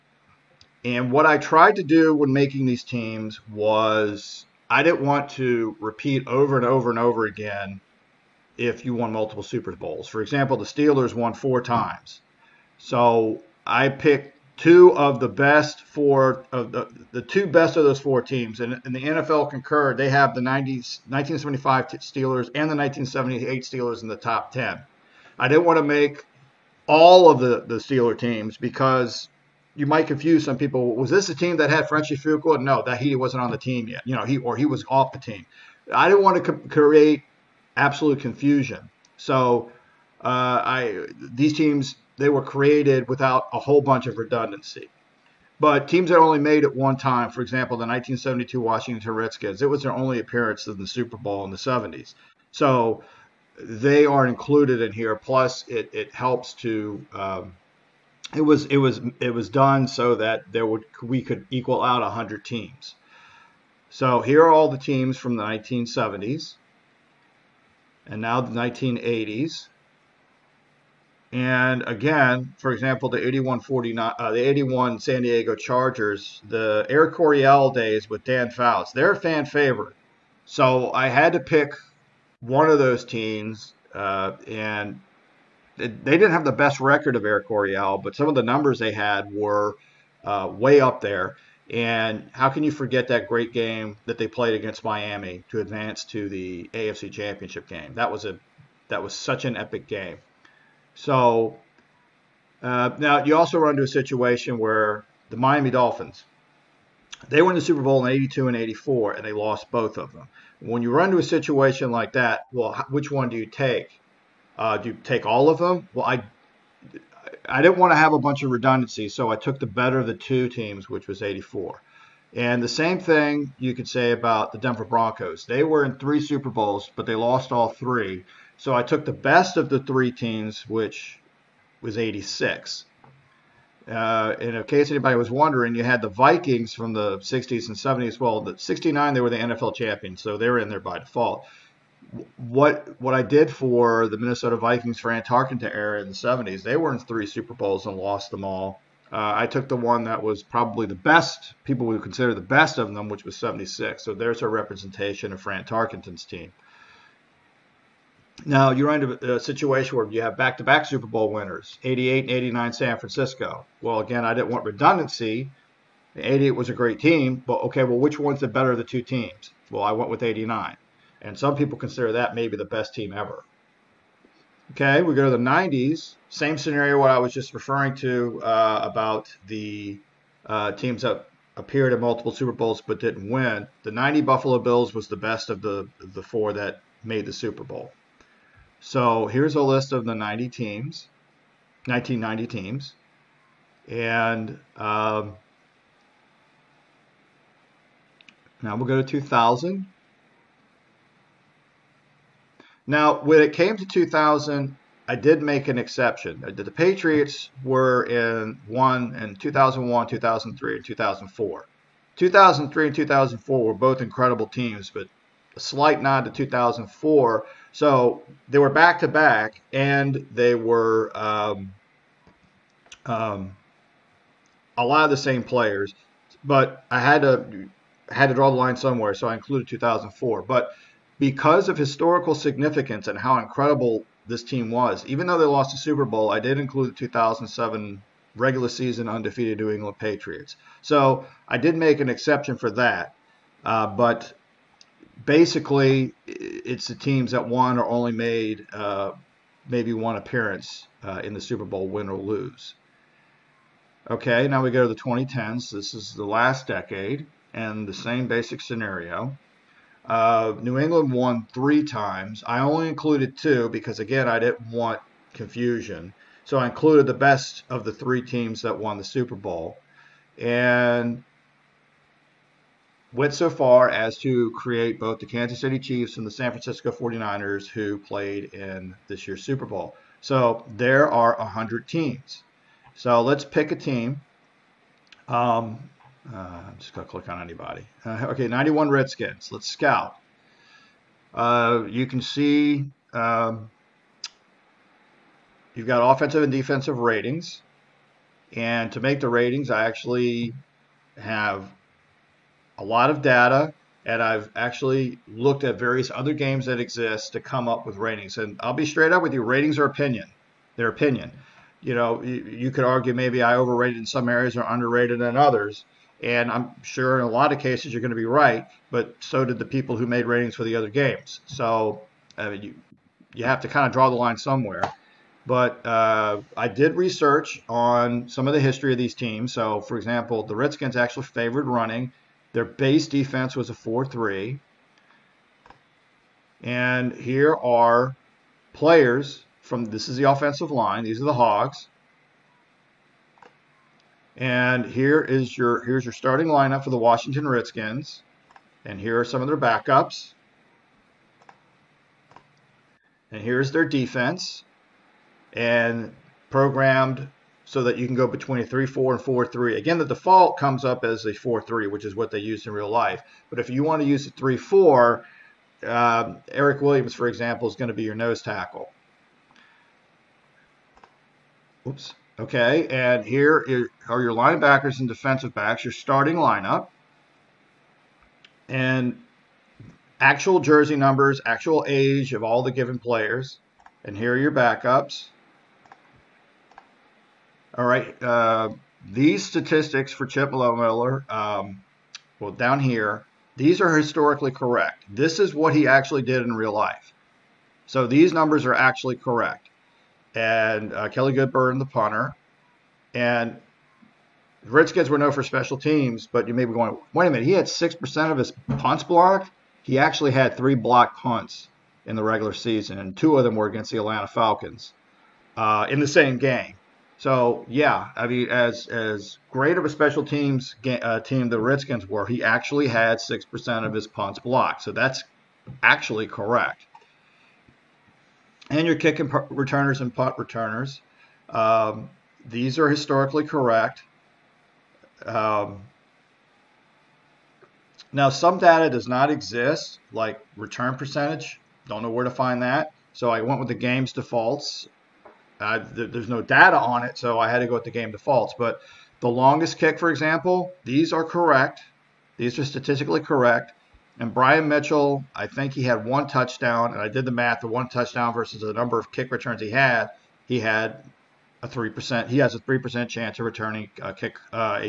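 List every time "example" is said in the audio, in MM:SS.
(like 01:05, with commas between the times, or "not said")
00:10, 00:47, 01:12, 05:29, 06:07, 07:30.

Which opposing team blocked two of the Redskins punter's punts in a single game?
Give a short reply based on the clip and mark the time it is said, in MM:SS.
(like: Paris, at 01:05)
Atlanta Falcons, at 06:53.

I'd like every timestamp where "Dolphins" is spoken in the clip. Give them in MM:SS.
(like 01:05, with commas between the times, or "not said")
01:45.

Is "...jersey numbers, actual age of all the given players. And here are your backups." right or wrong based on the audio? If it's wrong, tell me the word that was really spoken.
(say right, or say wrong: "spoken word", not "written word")
right.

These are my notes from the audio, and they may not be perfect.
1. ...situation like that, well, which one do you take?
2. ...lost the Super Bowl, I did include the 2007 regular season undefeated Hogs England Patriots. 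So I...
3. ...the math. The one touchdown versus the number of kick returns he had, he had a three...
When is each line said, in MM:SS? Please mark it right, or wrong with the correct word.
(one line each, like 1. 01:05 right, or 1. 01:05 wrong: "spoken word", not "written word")
1. 01:51 right
2. 03:55 wrong: "New", not "Hogs"
3. 07:37 right.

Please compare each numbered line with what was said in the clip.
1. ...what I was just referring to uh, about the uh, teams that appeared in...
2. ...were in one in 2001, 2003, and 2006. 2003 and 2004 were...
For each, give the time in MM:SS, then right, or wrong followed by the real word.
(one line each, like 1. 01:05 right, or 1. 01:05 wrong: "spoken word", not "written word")
1. 02:56 right
2. 03:27 wrong: "2004", not "2006".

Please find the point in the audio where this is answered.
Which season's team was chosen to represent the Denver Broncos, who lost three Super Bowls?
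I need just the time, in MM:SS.
02:11.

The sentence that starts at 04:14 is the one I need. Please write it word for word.
Okay, now we go to the 2010s.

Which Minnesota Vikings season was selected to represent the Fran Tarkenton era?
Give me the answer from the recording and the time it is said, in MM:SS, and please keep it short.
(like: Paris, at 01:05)
1976, at 02:33.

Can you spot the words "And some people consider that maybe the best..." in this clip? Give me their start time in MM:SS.
02:51.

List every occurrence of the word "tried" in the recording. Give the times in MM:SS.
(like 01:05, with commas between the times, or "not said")
00:01.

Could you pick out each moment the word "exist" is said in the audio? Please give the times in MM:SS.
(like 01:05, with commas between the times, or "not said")
05:06, 07:19.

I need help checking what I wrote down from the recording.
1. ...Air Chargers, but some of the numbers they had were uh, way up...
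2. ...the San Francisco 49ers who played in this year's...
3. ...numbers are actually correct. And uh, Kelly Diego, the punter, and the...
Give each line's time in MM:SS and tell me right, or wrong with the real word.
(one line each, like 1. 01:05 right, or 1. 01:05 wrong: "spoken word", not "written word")
1. 01:27 wrong: "Coryell", not "Chargers"
2. 04:36 right
3. 06:38 wrong: "Goodburn", not "Diego".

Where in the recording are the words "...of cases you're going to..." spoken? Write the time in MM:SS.
05:17.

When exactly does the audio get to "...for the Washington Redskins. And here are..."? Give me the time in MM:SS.
05:46.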